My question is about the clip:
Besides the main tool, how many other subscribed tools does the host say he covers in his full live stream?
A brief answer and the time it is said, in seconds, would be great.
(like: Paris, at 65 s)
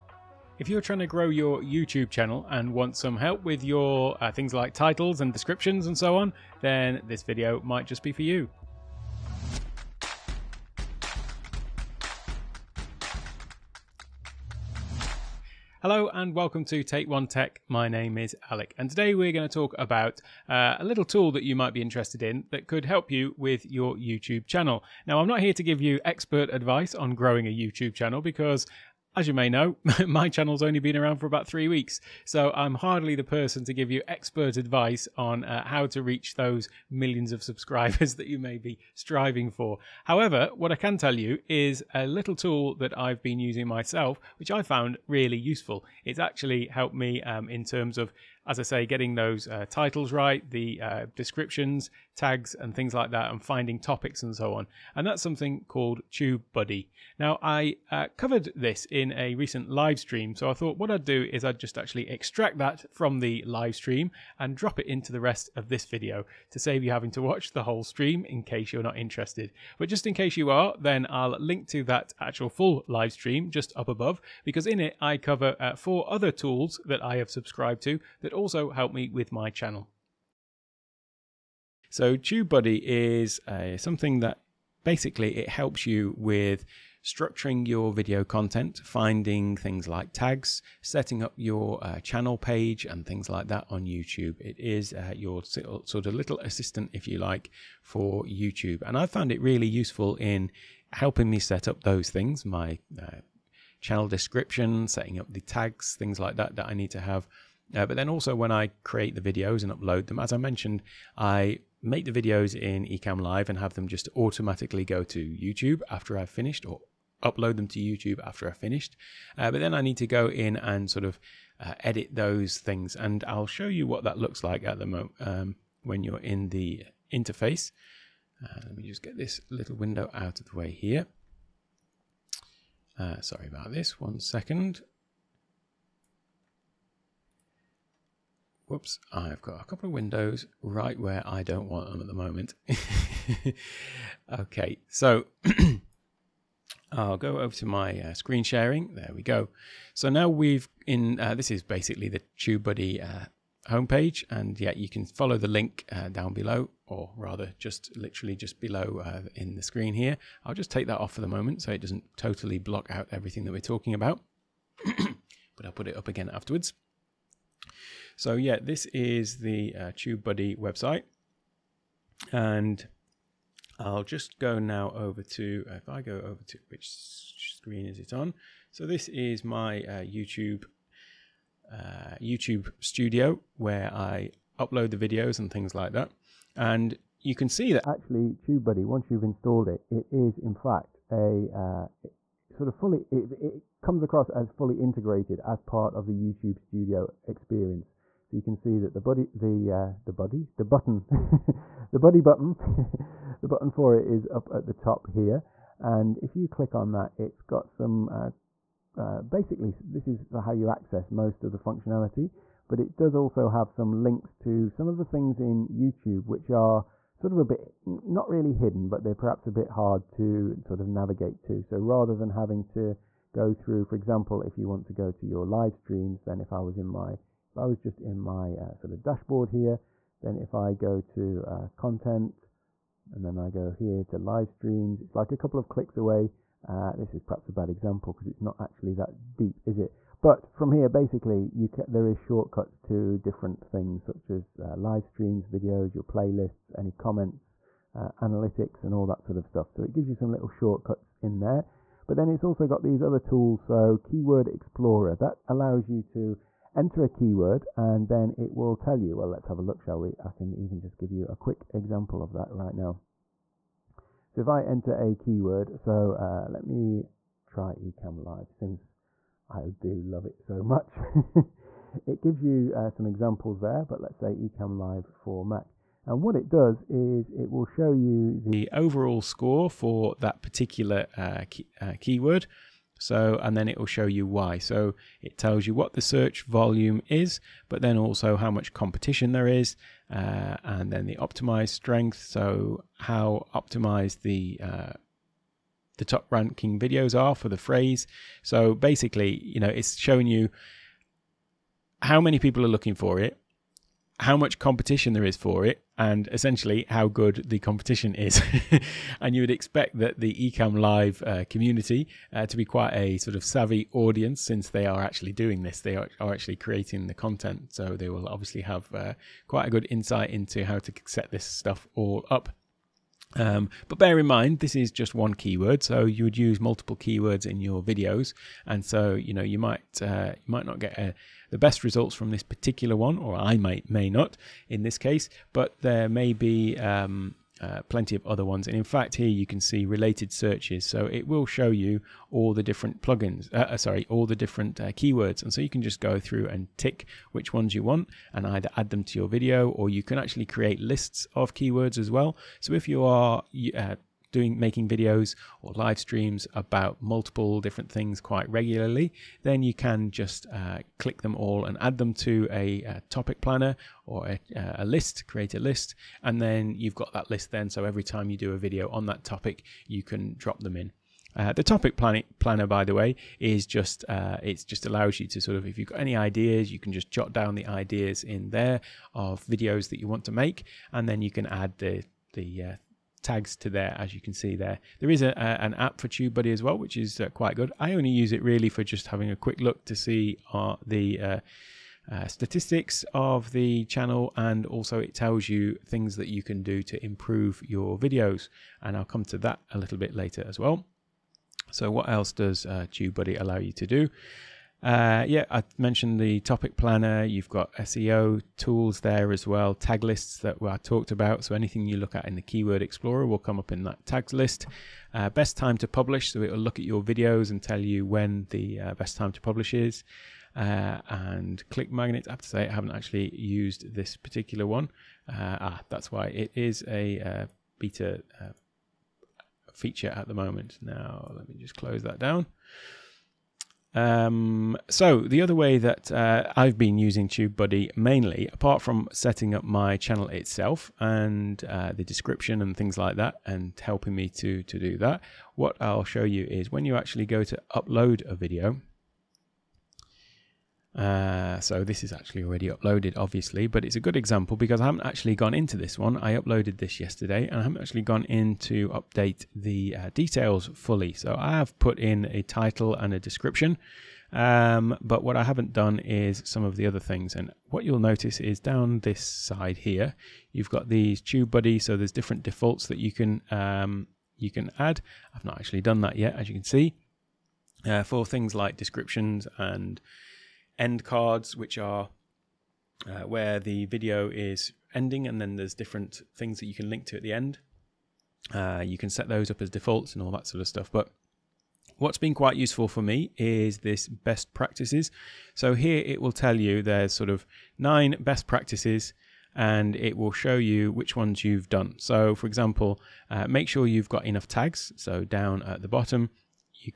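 four, at 75 s.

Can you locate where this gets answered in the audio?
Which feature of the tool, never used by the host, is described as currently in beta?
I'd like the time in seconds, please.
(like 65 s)
421 s.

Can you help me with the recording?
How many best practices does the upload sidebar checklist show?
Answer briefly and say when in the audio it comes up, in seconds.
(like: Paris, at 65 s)
9, at 497 s.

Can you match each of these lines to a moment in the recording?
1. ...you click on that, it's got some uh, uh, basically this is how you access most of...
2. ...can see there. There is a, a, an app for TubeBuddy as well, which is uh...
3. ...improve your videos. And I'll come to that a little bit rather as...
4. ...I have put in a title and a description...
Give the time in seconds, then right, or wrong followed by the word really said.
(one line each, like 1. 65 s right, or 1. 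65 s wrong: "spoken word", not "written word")
1. 206 s right
2. 384 s right
3. 397 s wrong: "later", not "rather"
4. 461 s right.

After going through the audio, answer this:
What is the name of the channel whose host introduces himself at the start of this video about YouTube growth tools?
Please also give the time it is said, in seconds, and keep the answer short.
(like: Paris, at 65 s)
Take One Tech, at 16 s.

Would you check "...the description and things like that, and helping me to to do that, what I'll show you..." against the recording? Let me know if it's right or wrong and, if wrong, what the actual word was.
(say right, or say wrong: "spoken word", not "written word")
right.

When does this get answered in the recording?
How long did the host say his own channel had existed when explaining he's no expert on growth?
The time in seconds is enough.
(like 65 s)
31 s.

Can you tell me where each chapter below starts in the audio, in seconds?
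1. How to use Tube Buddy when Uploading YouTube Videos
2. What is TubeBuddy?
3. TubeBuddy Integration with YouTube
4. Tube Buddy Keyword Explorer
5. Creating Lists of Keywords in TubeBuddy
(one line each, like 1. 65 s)
1. 449 s
2. 84 s
3. 194 s
4. 265 s
5. 354 s.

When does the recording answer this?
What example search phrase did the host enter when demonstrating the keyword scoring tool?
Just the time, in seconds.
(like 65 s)
274 s.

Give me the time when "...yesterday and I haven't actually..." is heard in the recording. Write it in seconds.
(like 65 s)
457 s.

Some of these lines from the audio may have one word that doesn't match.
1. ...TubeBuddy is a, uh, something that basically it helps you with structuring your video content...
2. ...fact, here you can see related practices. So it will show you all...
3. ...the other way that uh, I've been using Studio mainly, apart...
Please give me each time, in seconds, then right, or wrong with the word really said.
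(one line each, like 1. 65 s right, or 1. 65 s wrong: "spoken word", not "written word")
1. 82 s right
2. 338 s wrong: "searches", not "practices"
3. 435 s wrong: "TubeBuddy", not "Studio".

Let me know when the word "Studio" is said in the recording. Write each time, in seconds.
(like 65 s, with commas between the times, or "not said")
182 s, 196 s.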